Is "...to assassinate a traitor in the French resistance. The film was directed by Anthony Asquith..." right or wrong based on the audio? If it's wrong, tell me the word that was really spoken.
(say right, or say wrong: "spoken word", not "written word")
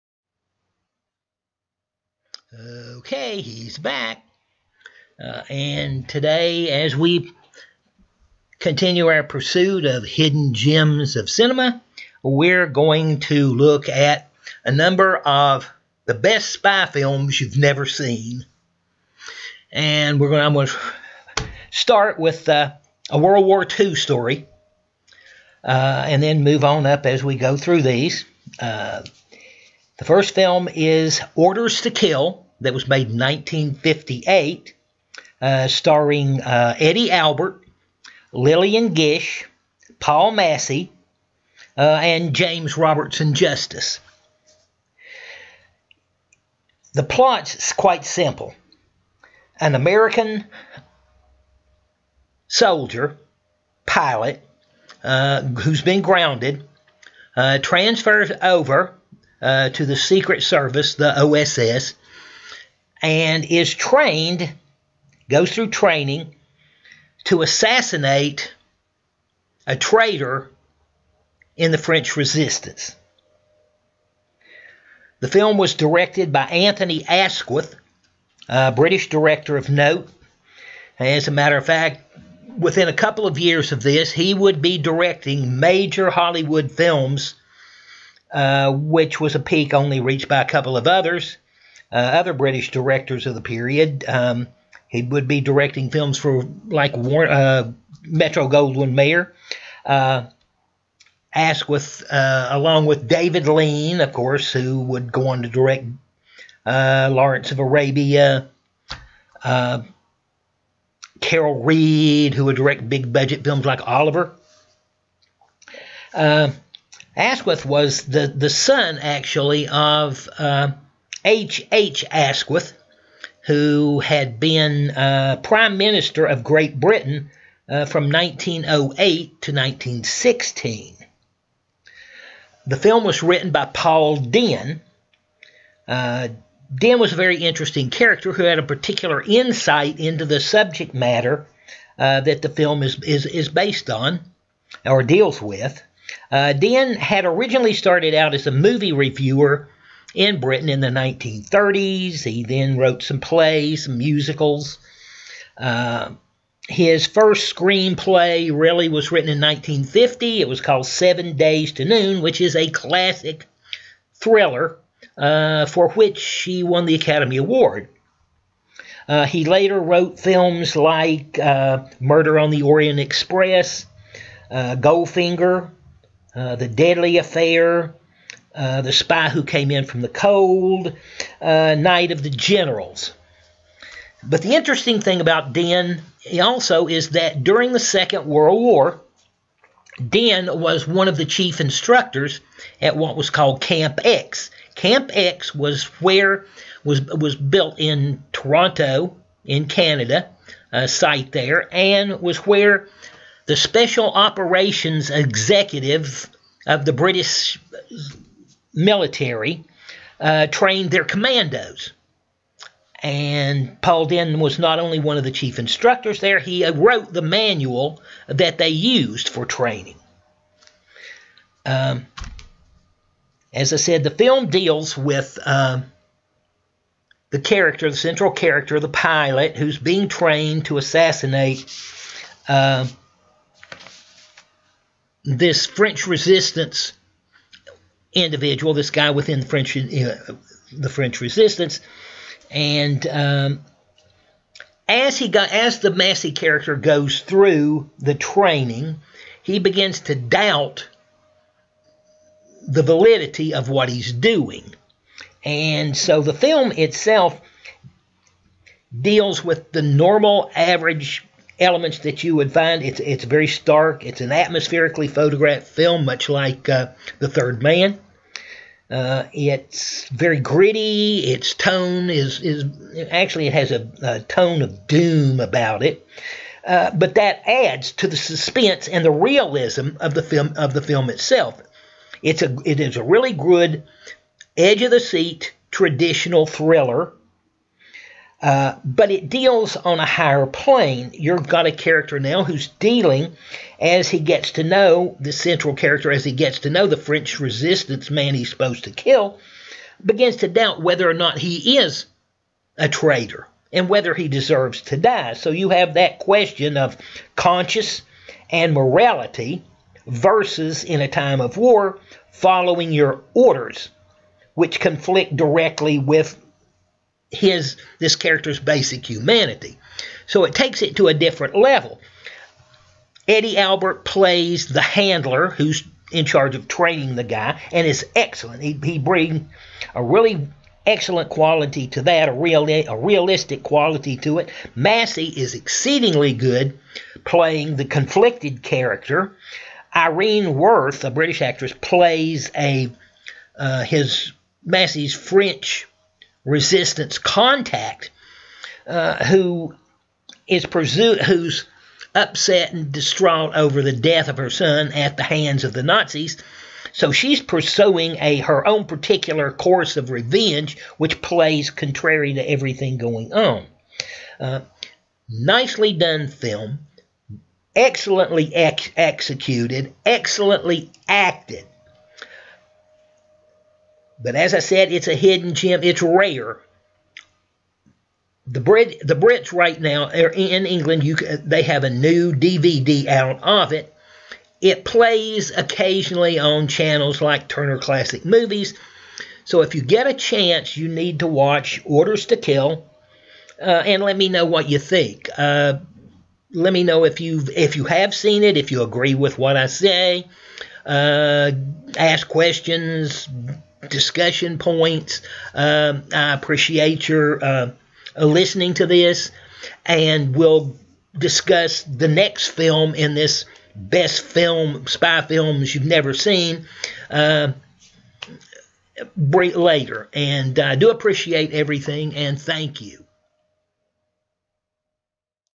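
right.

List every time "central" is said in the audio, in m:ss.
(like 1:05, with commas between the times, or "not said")
3:47, 4:55.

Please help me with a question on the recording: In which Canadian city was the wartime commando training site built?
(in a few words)
Toronto.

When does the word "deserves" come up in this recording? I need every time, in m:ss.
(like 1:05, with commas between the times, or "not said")
5:04.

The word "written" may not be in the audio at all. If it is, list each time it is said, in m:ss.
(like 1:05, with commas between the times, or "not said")
2:13, 2:39.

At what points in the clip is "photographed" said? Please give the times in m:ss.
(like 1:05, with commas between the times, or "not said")
4:25.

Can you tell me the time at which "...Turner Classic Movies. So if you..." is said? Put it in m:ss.
6:27.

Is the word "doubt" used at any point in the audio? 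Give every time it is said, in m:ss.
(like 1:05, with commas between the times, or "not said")
4:10, 5:00.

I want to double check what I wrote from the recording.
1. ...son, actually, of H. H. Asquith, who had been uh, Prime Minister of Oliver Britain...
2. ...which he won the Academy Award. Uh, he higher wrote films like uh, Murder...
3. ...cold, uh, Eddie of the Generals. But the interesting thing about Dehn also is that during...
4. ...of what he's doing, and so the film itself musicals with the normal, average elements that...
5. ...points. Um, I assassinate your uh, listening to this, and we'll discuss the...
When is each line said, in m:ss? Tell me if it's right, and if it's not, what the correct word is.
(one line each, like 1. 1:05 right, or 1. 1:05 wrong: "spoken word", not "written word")
1. 1:58 wrong: "Great", not "Oliver"
2. 2:45 wrong: "later", not "higher"
3. 3:00 wrong: "Night", not "Eddie"
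4. 4:13 wrong: "deals", not "musicals"
5. 6:44 wrong: "appreciate", not "assassinate".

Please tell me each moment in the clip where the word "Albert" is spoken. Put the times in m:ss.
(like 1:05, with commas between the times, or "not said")
0:37, 5:23.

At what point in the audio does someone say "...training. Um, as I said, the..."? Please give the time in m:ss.
3:39.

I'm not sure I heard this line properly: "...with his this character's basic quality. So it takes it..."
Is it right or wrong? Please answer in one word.
wrong.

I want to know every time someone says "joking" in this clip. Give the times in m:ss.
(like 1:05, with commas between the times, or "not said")
not said.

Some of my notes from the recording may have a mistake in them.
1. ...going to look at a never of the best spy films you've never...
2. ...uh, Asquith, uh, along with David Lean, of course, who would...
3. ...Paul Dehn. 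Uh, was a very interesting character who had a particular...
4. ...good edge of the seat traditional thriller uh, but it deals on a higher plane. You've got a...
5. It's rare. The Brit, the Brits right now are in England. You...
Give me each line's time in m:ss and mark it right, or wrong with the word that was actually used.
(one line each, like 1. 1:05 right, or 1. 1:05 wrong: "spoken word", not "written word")
1. 0:12 wrong: "number", not "never"
2. 1:39 right
3. 2:13 right
4. 4:43 right
5. 6:15 right.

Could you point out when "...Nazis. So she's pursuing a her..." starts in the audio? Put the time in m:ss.
5:55.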